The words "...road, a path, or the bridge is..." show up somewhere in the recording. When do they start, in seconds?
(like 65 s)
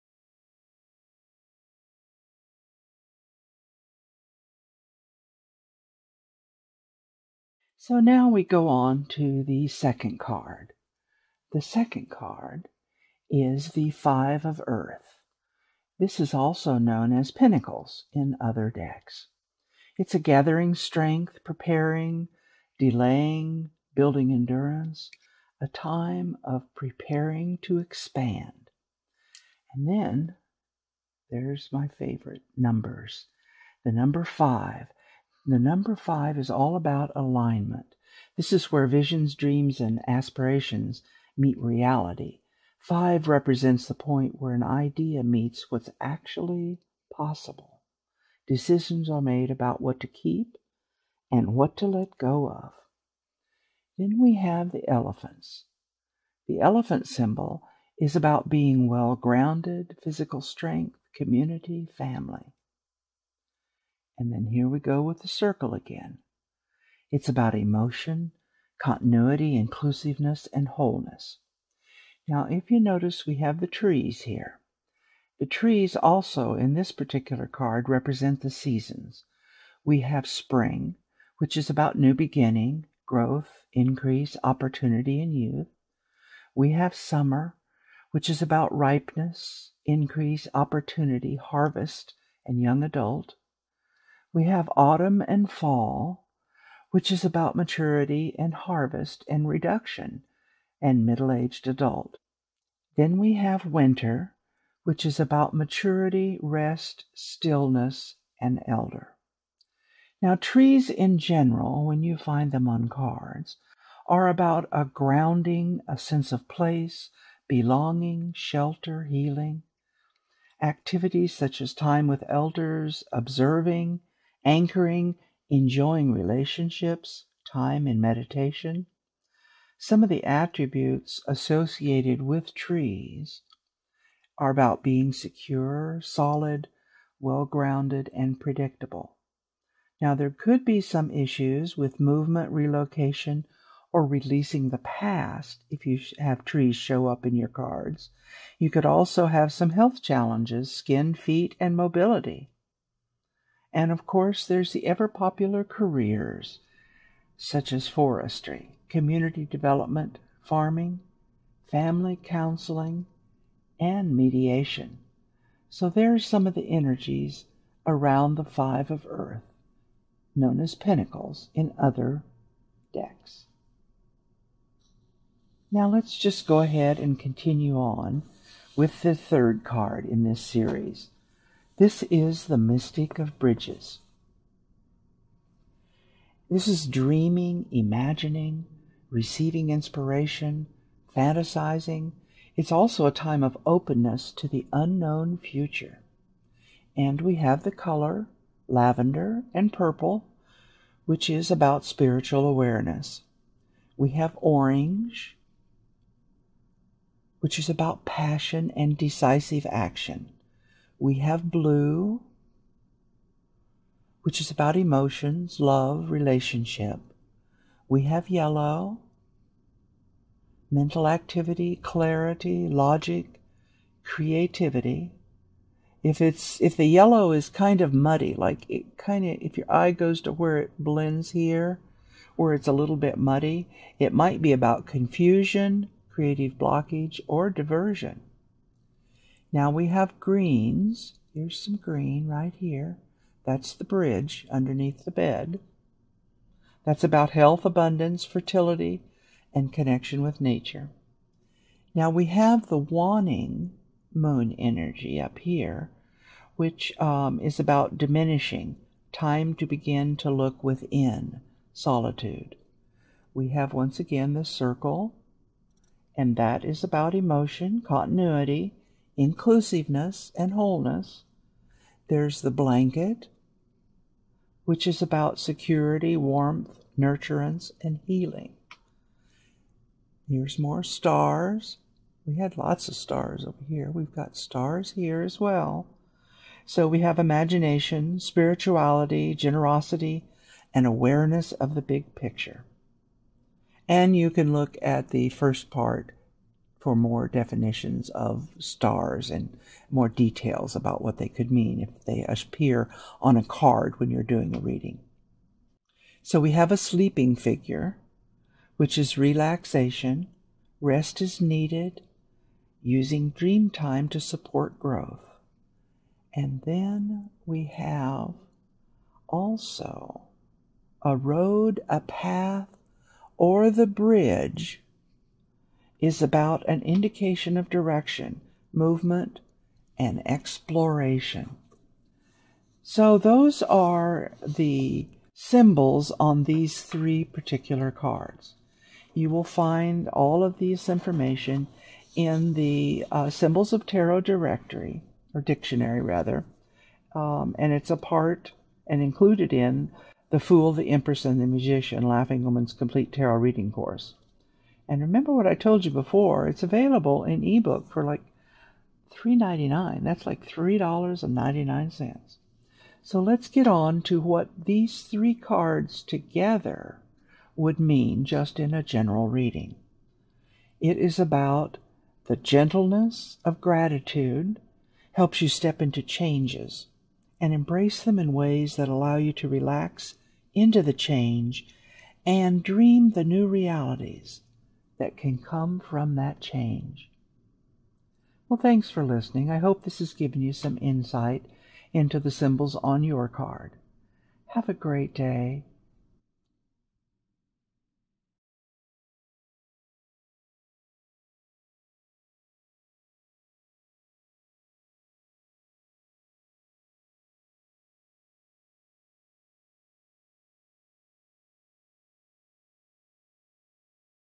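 321 s.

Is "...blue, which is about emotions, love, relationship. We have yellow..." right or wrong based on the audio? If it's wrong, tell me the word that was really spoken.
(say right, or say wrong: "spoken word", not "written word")
right.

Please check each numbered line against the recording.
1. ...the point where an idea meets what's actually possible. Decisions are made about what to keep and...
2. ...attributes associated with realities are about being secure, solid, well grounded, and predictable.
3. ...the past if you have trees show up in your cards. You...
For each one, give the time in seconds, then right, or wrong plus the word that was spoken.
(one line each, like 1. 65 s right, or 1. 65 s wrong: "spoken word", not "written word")
1. 43 s right
2. 130 s wrong: "trees", not "realities"
3. 144 s right.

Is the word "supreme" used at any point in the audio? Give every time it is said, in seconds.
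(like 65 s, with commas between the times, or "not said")
not said.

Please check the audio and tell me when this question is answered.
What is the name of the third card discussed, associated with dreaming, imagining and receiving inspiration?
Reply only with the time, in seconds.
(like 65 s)
182 s.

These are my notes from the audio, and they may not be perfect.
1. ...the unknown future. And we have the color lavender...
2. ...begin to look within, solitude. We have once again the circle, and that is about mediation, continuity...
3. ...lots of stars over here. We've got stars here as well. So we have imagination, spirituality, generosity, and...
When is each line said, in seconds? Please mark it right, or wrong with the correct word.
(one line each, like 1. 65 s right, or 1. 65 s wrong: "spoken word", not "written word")
1. 194 s right
2. 259 s wrong: "emotion", not "mediation"
3. 282 s right.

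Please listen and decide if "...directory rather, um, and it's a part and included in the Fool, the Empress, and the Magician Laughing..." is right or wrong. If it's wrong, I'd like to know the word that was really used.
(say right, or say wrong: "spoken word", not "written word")
wrong: "dictionary", not "directory".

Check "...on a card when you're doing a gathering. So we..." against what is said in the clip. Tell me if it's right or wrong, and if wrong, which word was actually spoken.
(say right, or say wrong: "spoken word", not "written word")
wrong: "reading", not "gathering".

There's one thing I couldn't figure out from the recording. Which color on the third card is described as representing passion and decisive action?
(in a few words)
Orange.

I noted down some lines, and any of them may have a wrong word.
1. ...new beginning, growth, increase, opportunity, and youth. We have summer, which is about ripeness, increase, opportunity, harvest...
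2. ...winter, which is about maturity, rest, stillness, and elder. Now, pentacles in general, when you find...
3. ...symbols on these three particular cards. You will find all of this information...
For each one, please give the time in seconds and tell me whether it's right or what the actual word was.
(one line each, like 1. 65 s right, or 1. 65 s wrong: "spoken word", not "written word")
1. 81 s right
2. 103 s wrong: "trees", not "pentacles"
3. 335 s right.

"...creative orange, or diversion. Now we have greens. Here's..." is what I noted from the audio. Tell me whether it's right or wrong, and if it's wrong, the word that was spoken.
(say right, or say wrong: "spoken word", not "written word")
wrong: "blockage", not "orange".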